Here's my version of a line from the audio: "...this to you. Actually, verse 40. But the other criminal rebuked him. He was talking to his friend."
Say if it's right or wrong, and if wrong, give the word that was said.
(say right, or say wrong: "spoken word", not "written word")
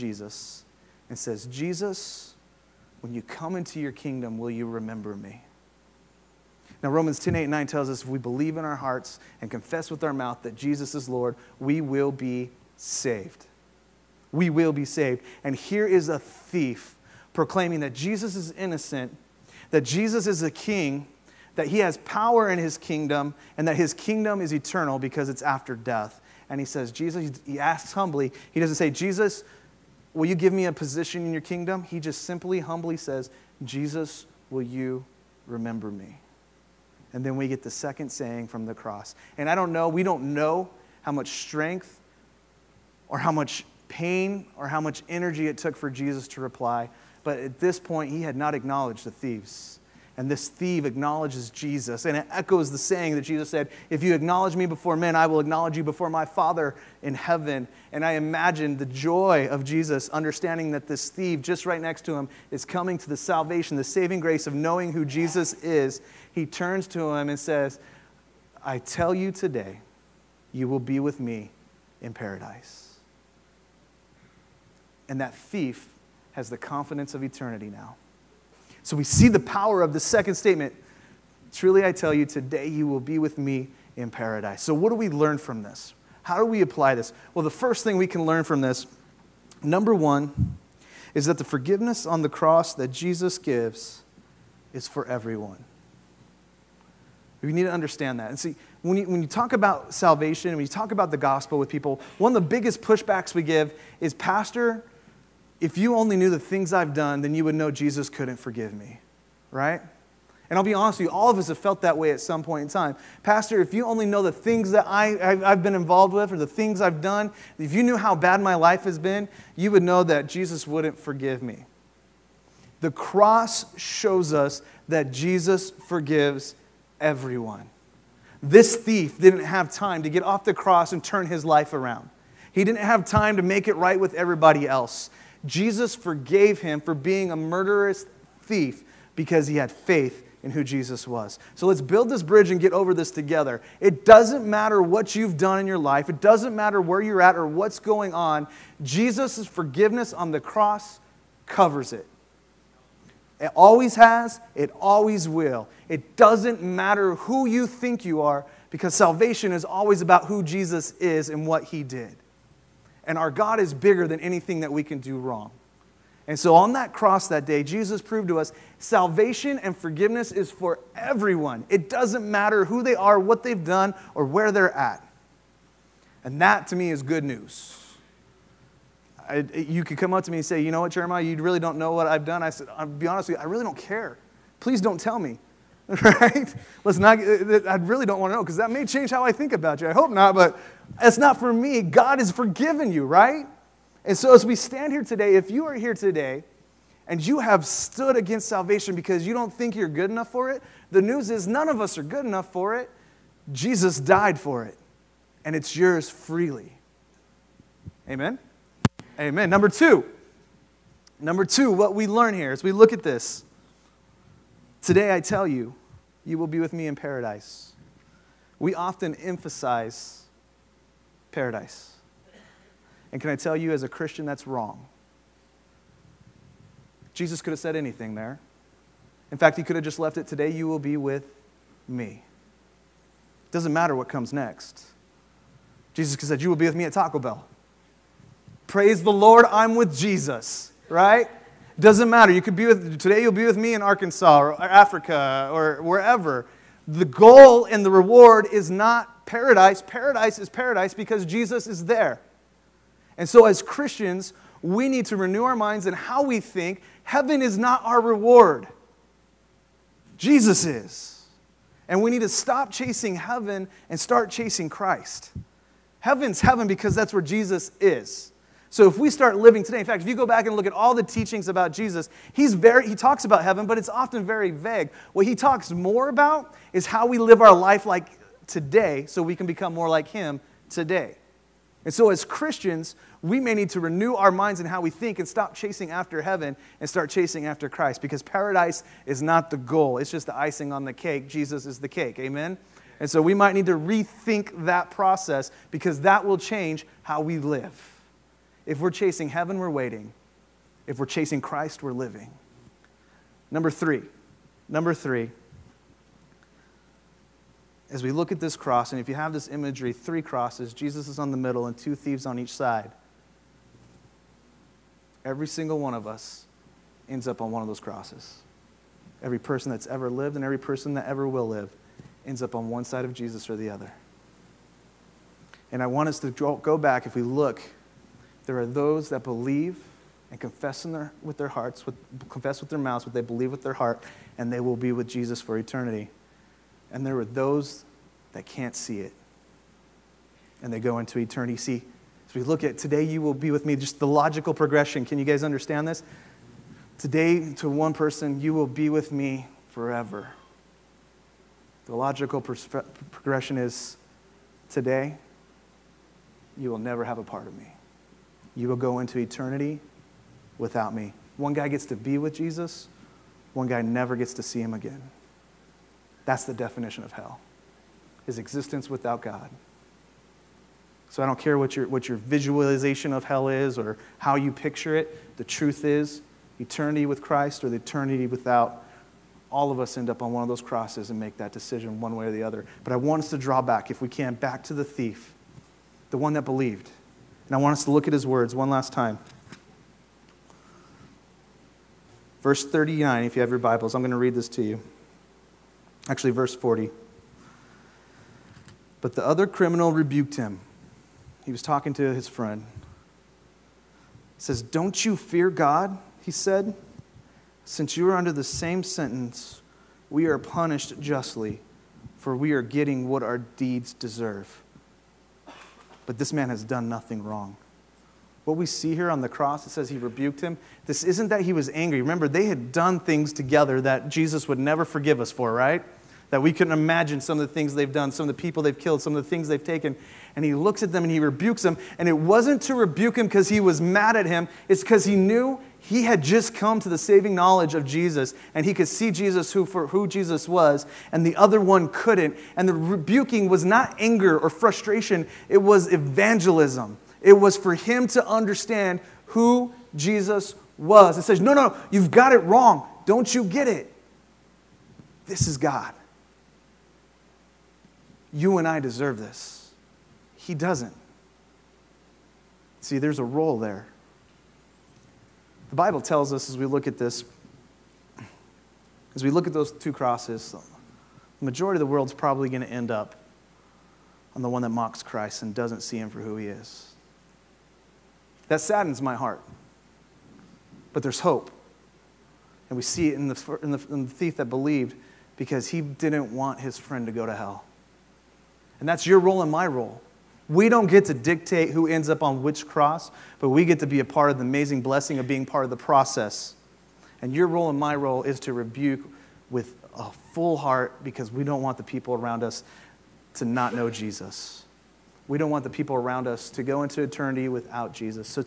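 right.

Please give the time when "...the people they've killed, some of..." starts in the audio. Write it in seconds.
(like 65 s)
428 s.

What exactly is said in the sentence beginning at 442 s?
And the rebuking was not anger or frustration, it was evangelism.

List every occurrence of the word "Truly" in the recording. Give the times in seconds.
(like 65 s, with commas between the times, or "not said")
81 s.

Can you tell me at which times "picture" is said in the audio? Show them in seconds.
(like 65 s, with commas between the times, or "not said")
374 s.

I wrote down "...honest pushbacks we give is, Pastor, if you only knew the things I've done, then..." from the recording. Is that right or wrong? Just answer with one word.
wrong.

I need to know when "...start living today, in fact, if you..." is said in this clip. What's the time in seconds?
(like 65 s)
269 s.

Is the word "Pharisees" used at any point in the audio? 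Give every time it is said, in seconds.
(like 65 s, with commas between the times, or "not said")
not said.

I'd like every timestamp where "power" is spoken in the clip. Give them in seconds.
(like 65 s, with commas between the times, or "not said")
22 s, 79 s.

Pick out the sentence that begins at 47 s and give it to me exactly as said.
But at this point, he had not acknowledged the thieves.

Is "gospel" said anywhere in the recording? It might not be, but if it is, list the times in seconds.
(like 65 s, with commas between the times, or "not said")
101 s.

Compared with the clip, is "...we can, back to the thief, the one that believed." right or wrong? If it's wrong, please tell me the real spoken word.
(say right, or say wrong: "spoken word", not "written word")
right.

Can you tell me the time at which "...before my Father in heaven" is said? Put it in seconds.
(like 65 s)
55 s.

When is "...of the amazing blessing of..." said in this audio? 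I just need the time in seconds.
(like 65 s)
494 s.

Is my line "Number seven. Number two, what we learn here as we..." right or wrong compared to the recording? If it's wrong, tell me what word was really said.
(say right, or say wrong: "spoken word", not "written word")
wrong: "two", not "seven".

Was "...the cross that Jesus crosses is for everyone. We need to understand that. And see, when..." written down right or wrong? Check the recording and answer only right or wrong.
wrong.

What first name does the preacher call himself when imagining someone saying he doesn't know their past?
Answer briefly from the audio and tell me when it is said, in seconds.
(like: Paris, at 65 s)
Jeremiah, at 180 s.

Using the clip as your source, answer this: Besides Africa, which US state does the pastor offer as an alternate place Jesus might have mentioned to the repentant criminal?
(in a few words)
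Arkansas.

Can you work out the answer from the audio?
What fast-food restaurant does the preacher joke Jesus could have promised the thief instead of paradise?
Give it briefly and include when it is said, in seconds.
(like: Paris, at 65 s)
Taco Bell, at 236 s.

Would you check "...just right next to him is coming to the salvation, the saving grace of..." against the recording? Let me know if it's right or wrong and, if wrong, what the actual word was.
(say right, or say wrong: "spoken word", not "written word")
right.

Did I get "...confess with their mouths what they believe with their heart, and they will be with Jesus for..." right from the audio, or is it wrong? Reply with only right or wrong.
right.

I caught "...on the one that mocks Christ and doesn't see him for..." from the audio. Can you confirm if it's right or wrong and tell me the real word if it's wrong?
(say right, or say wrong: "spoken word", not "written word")
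right.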